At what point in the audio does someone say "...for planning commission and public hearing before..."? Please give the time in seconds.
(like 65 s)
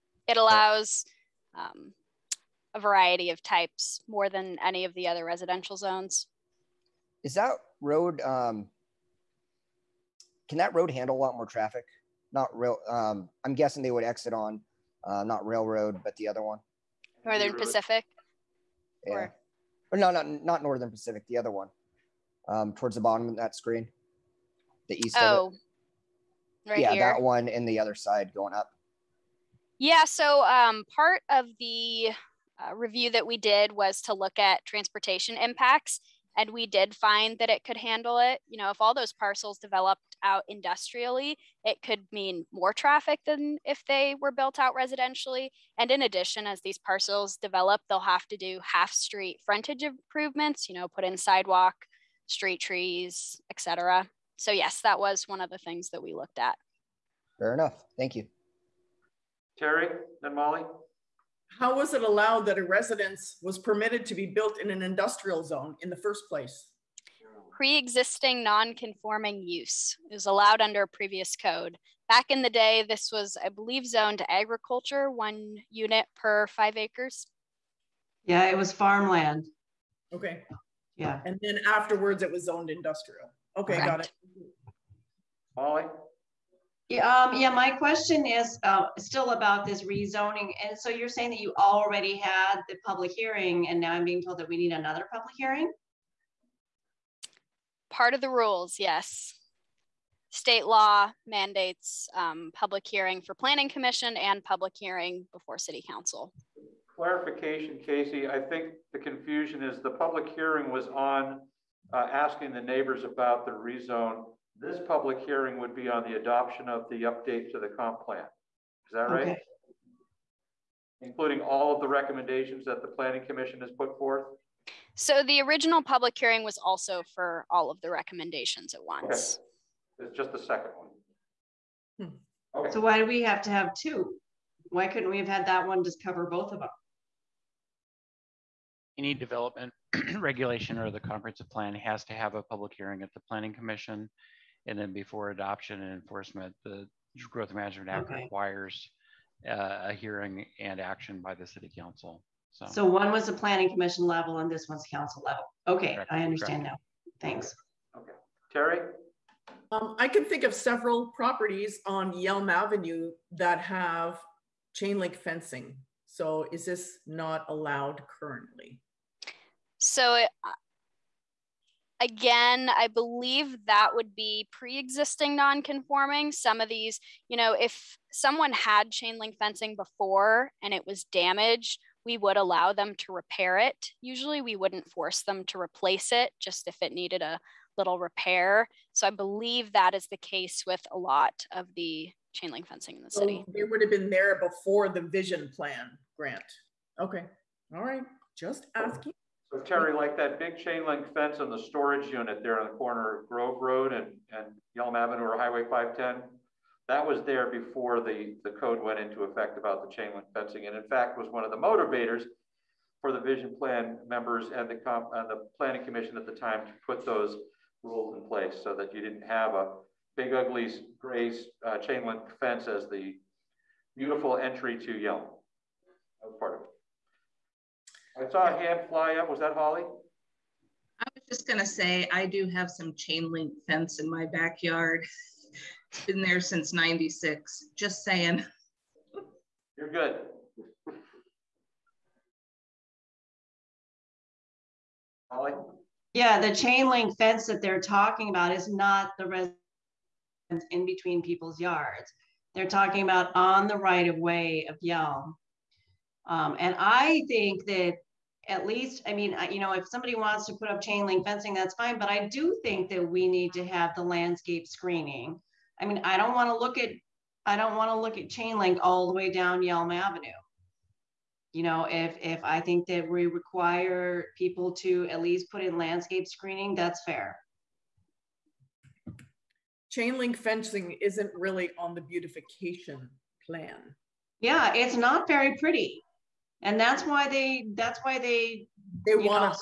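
103 s.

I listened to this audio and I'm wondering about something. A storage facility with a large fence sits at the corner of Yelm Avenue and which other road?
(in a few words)
Grove Road.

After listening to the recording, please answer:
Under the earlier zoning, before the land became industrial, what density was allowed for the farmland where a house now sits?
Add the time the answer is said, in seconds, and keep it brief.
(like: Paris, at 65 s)
1 unit per 5 acres, at 75 s.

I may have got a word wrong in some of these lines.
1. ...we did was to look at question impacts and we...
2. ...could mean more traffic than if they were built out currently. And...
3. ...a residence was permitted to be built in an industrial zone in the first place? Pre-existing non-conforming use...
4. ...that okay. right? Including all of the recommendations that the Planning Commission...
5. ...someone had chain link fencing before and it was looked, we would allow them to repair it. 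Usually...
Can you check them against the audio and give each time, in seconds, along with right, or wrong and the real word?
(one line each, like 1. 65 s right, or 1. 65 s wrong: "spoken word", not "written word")
1. 33 s wrong: "transportation", not "question"
2. 41 s wrong: "residentially", not "currently"
3. 62 s right
4. 118 s right
5. 178 s wrong: "damaged", not "looked".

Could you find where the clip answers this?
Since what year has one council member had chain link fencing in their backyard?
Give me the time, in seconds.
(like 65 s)
236 s.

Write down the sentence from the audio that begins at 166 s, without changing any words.
So is this not allowed currently?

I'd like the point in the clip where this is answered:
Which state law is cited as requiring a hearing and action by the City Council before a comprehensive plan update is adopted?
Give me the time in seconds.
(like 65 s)
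147 s.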